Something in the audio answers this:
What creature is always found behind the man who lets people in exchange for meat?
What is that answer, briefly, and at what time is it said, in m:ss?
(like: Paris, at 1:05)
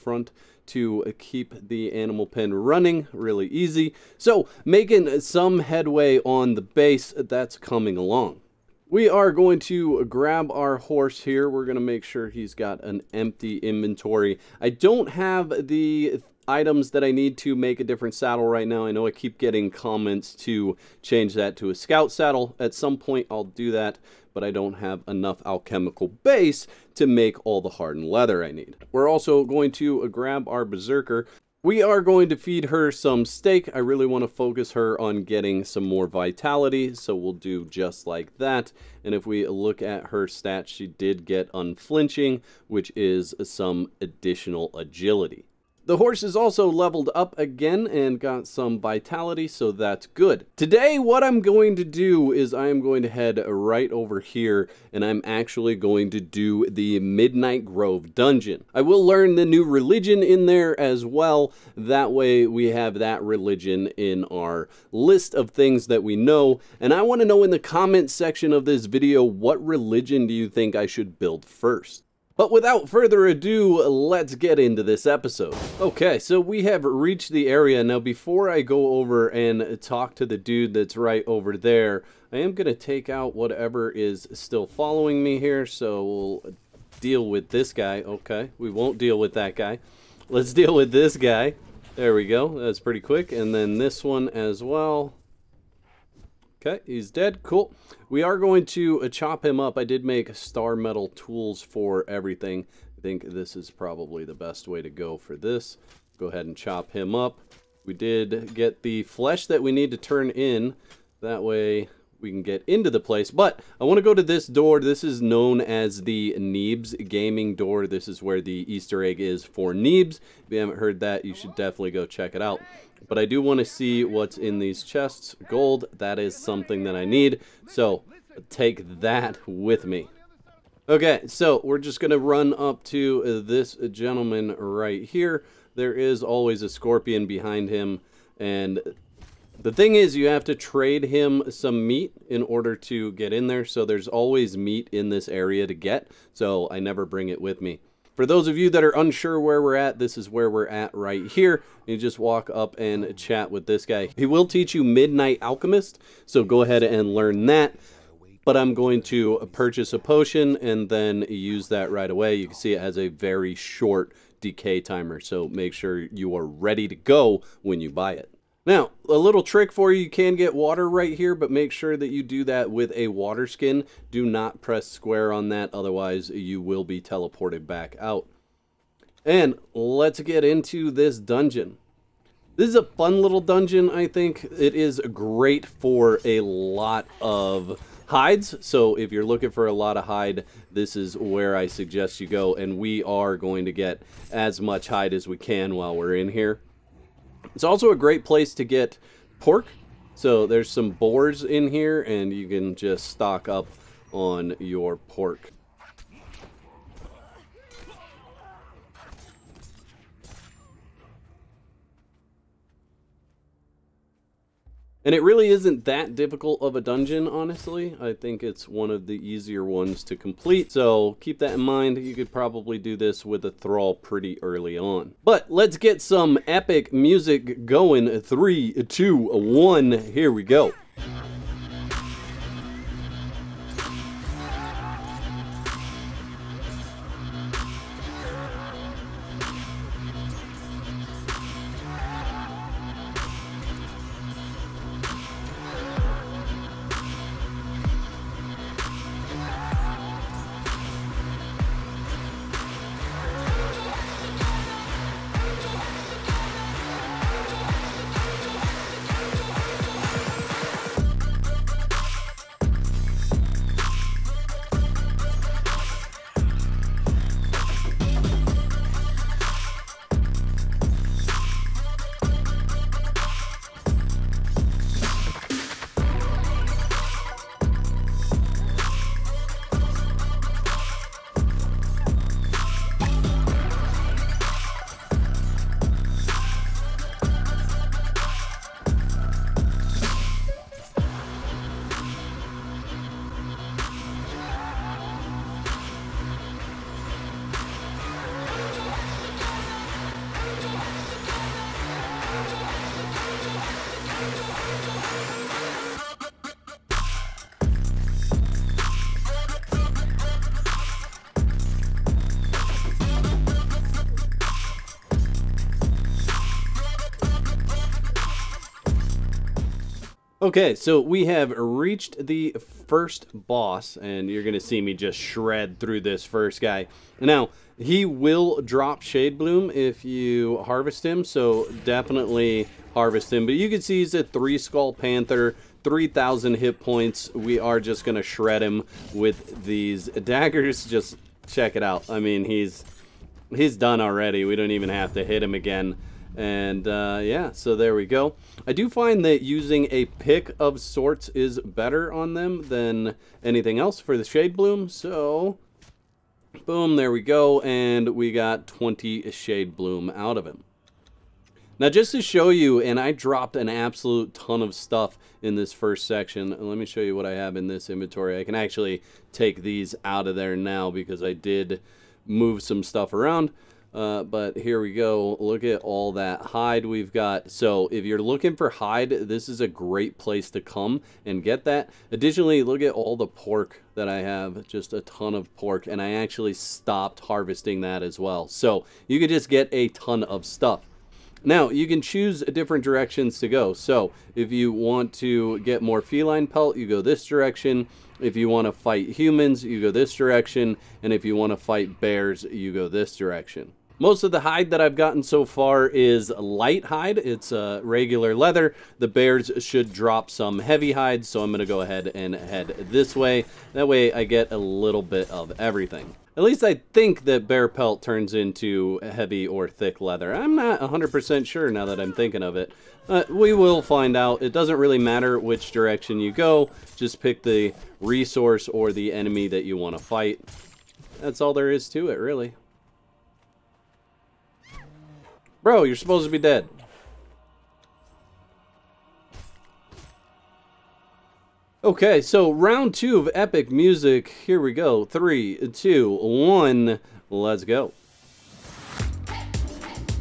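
Scorpion, at 2:16.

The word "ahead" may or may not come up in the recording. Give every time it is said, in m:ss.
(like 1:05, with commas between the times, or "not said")
1:46, 2:36, 6:51.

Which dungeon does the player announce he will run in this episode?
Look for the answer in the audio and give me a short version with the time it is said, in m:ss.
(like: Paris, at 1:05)
Midnight Grove, at 0:56.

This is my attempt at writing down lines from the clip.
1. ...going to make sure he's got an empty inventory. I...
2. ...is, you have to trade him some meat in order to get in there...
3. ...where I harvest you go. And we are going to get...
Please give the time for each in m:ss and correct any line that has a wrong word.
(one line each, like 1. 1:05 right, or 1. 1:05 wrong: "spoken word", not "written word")
1. 0:11 right
2. 2:19 right
3. 3:11 wrong: "suggest", not "harvest".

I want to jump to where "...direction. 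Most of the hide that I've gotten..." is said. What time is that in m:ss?
6:43.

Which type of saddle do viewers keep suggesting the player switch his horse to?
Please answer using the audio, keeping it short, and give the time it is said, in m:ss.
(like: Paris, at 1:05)
Scout saddle, at 0:21.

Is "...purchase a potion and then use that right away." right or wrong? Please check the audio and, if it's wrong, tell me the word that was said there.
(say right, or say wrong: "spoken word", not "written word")
right.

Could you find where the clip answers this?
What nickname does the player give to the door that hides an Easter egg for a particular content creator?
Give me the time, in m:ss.
1:56.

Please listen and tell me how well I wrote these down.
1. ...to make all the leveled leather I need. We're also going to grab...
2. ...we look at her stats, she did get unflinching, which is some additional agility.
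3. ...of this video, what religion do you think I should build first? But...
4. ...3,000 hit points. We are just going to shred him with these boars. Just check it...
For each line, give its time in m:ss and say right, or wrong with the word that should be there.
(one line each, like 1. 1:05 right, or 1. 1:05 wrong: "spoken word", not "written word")
1. 0:26 wrong: "hardened", not "leveled"
2. 0:39 right
3. 1:08 right
4. 5:35 wrong: "daggers", not "boars".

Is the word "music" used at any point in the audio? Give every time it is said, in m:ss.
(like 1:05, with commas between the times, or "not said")
3:46, 7:23.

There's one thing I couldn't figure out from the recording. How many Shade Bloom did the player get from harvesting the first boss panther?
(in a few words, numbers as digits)
20.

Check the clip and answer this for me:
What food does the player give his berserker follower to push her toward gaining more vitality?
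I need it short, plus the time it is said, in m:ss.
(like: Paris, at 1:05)
Steak, at 0:33.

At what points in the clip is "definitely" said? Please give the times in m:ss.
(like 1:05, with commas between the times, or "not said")
2:01, 5:31.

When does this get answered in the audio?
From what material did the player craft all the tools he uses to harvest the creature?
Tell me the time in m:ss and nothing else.
1:40.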